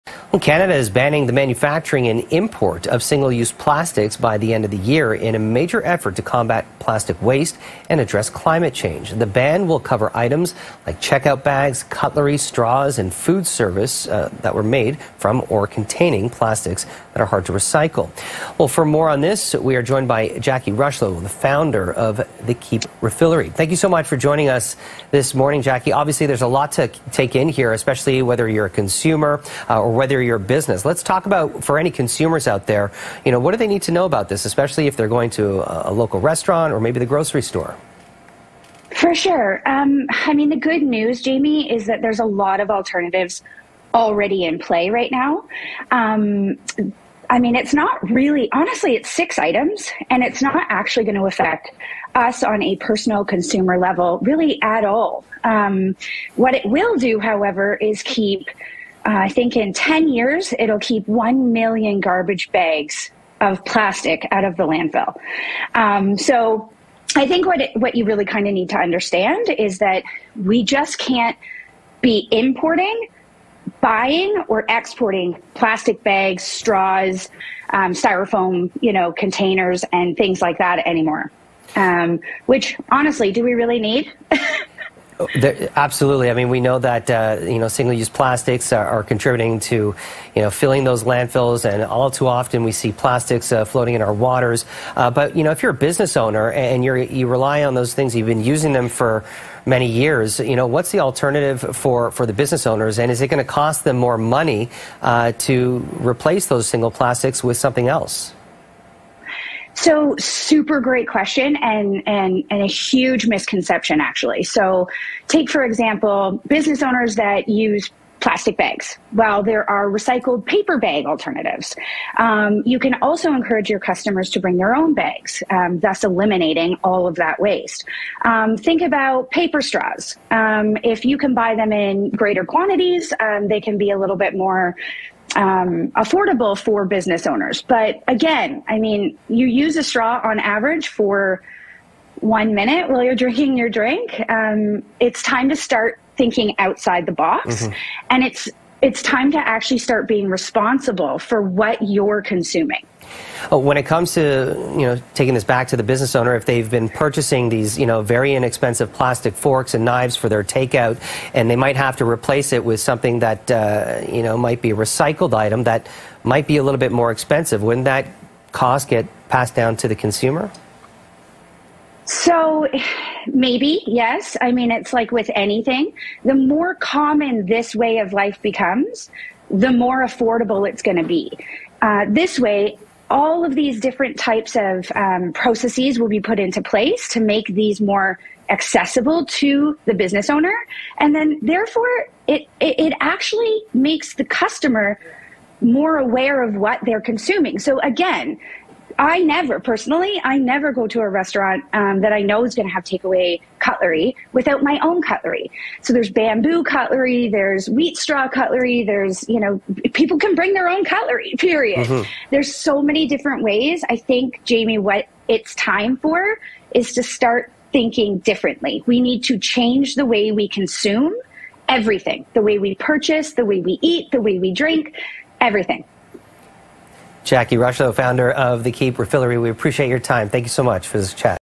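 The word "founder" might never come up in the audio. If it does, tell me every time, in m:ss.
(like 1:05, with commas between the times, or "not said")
0:21, 3:47.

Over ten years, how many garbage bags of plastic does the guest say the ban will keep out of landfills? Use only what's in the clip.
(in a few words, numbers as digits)
1 million.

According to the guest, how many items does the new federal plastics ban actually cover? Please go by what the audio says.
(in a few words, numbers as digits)
6.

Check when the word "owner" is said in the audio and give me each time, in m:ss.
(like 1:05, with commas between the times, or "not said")
1:36, 1:42, 1:56, 2:17, 2:36, 3:10.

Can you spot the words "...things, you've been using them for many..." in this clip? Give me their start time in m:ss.
1:37.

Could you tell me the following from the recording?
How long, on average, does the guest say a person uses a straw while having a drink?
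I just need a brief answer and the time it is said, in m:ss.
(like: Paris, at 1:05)
1 minute, at 2:22.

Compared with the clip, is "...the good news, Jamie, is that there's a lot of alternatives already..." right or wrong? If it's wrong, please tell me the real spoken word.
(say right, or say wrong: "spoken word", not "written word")
right.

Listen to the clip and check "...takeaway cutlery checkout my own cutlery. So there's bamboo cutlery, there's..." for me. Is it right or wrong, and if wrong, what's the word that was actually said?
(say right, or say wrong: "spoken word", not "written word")
wrong: "without", not "checkout".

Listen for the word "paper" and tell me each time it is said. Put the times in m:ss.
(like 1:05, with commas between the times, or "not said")
2:00, 2:09.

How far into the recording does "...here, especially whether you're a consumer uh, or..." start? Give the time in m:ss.
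0:27.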